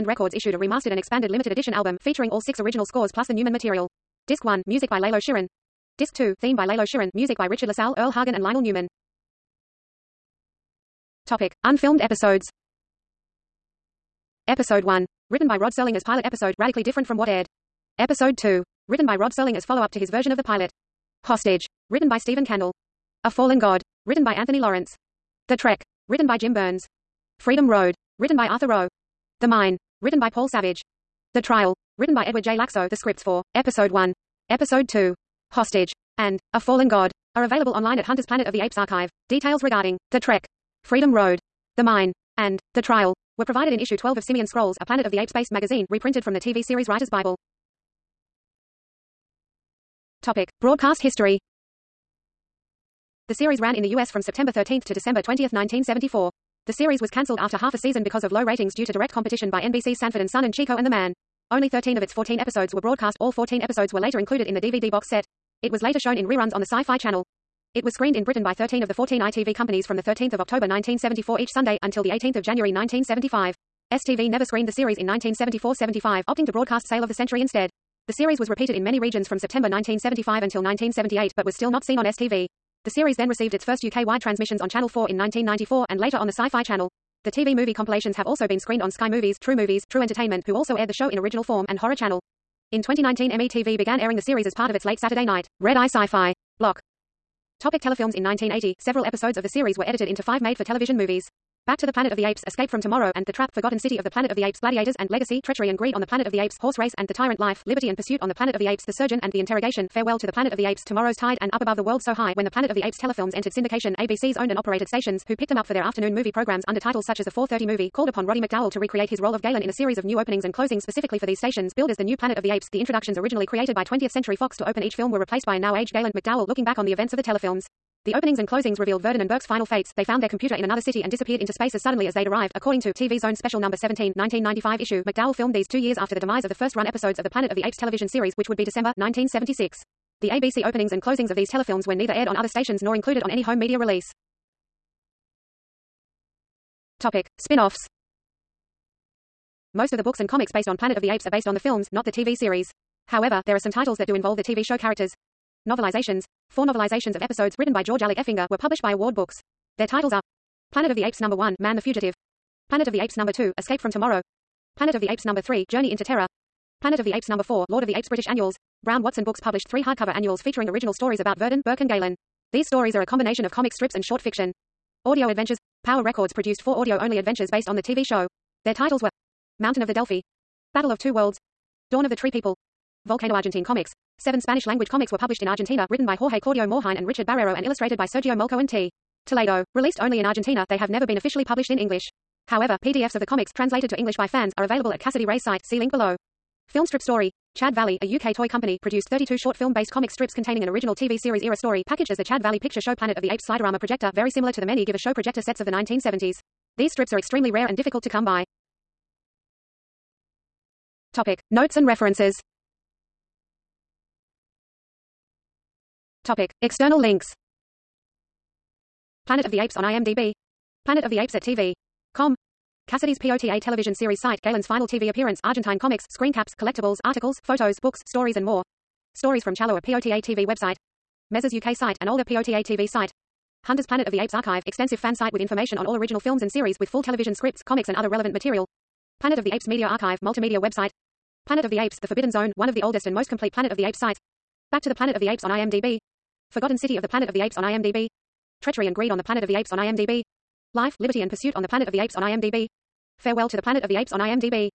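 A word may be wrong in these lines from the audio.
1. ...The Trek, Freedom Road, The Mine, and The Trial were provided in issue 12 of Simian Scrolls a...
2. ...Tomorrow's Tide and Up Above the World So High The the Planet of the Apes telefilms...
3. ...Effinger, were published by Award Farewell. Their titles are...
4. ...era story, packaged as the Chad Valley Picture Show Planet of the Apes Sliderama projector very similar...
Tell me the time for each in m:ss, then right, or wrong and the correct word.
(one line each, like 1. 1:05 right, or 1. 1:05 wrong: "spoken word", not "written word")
1. 0:40 right
2. 1:50 wrong: "When", not "The"
3. 2:38 wrong: "Books", not "Farewell"
4. 3:21 right.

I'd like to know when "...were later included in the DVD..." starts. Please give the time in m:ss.
1:03.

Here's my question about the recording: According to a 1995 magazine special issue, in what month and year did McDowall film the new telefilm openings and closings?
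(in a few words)
December 1976.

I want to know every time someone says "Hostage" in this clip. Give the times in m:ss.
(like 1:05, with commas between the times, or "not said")
0:21, 0:35.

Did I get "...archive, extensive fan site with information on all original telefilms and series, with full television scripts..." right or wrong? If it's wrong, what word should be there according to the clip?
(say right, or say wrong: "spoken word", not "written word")
wrong: "films", not "telefilms".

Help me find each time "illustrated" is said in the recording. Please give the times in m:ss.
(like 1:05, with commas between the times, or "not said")
3:07.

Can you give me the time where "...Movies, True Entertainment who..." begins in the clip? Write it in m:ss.
1:29.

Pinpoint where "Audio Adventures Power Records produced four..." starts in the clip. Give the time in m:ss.
2:55.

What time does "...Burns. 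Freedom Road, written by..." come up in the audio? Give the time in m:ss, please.
0:26.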